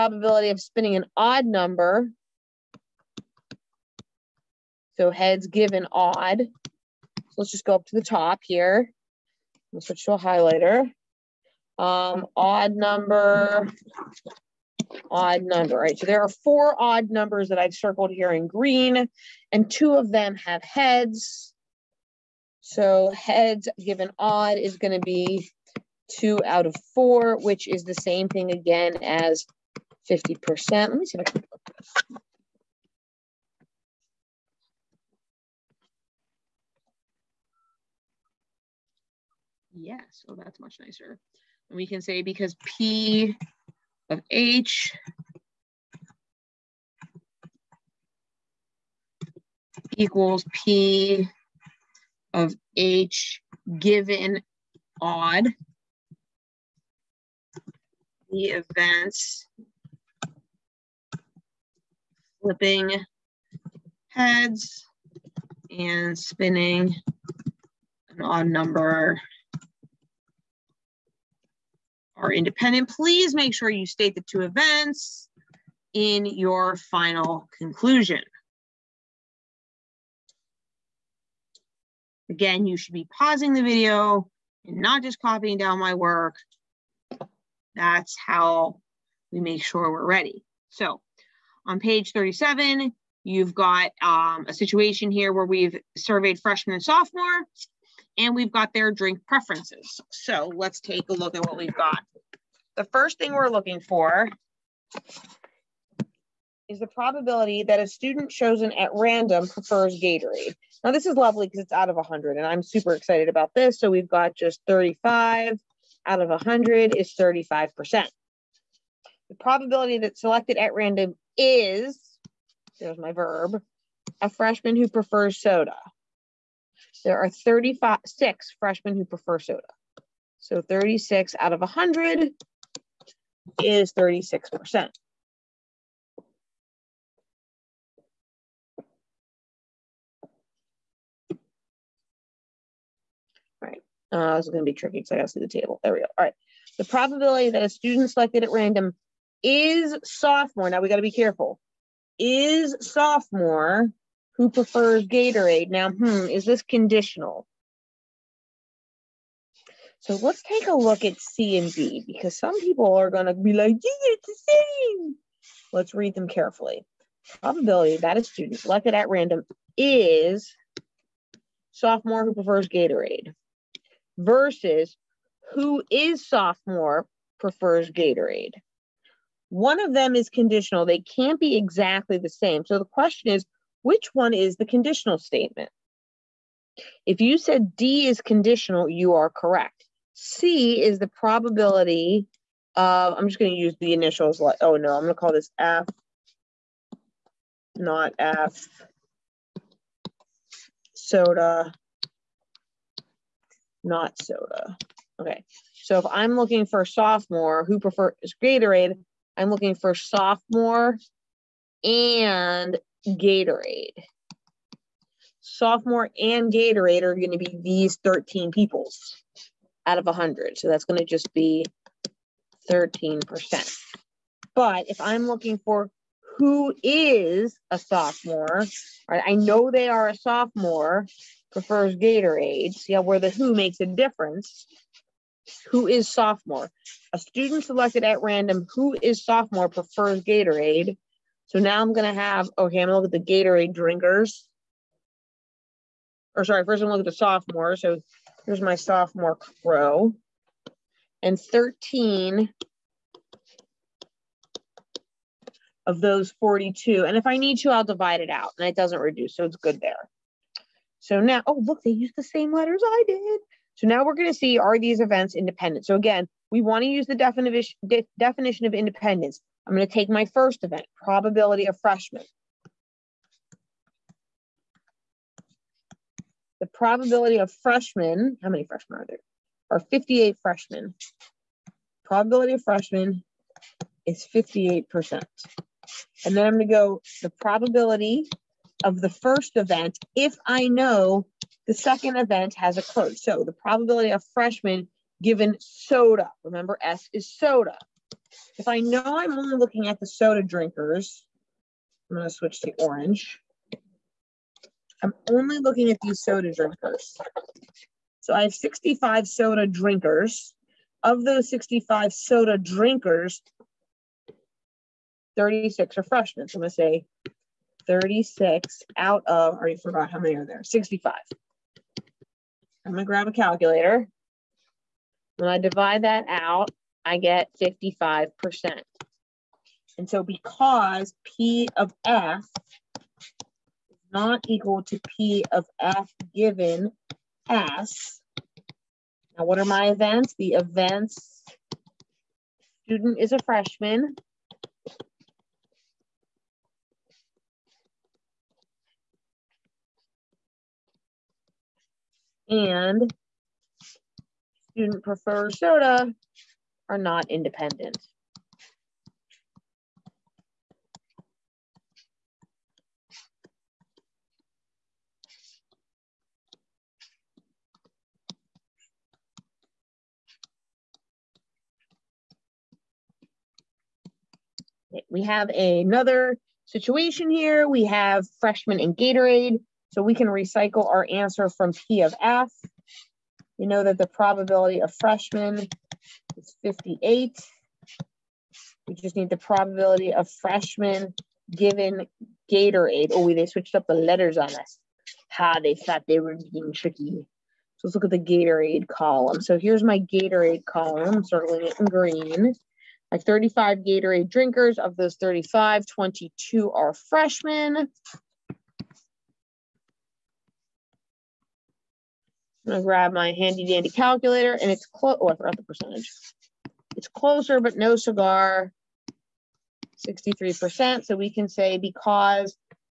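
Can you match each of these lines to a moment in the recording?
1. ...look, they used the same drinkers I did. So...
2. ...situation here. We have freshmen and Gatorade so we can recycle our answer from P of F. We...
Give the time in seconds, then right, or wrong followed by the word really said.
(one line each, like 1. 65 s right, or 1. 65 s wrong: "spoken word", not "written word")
1. 261 s wrong: "letters", not "drinkers"
2. 376 s right.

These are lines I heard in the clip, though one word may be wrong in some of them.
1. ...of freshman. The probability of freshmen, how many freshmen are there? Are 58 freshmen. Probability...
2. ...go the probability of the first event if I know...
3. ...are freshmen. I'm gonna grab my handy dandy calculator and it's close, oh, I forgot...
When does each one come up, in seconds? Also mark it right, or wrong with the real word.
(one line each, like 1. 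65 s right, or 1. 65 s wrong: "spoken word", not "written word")
1. 271 s right
2. 286 s right
3. 406 s right.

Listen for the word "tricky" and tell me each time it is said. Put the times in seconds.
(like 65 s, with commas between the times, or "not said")
144 s, 396 s.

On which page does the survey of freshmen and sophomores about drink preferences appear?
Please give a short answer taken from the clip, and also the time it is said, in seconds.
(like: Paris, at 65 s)
37, at 91 s.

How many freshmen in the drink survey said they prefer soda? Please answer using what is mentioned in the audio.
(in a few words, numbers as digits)
36.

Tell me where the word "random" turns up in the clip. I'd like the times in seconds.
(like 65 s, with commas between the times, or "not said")
108 s, 120 s, 148 s, 169 s, 238 s.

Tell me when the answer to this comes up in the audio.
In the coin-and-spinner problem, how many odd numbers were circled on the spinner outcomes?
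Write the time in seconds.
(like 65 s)
16 s.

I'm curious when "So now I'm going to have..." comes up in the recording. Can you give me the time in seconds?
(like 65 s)
241 s.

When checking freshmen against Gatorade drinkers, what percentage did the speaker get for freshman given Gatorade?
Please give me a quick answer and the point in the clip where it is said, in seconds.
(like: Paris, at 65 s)
63%, at 420 s.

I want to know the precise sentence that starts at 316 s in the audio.
So I'm gonna say 36 out of, or you forgot how many are there, 65.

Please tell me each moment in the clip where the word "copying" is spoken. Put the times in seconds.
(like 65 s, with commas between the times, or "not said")
85 s.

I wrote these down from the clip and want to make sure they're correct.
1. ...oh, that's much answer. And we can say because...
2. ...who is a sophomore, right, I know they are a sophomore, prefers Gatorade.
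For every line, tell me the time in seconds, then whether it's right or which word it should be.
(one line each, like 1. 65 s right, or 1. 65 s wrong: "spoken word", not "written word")
1. 40 s wrong: "nicer", not "answer"
2. 226 s right.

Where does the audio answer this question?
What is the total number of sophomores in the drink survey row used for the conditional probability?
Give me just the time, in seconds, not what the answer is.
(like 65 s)
251 s.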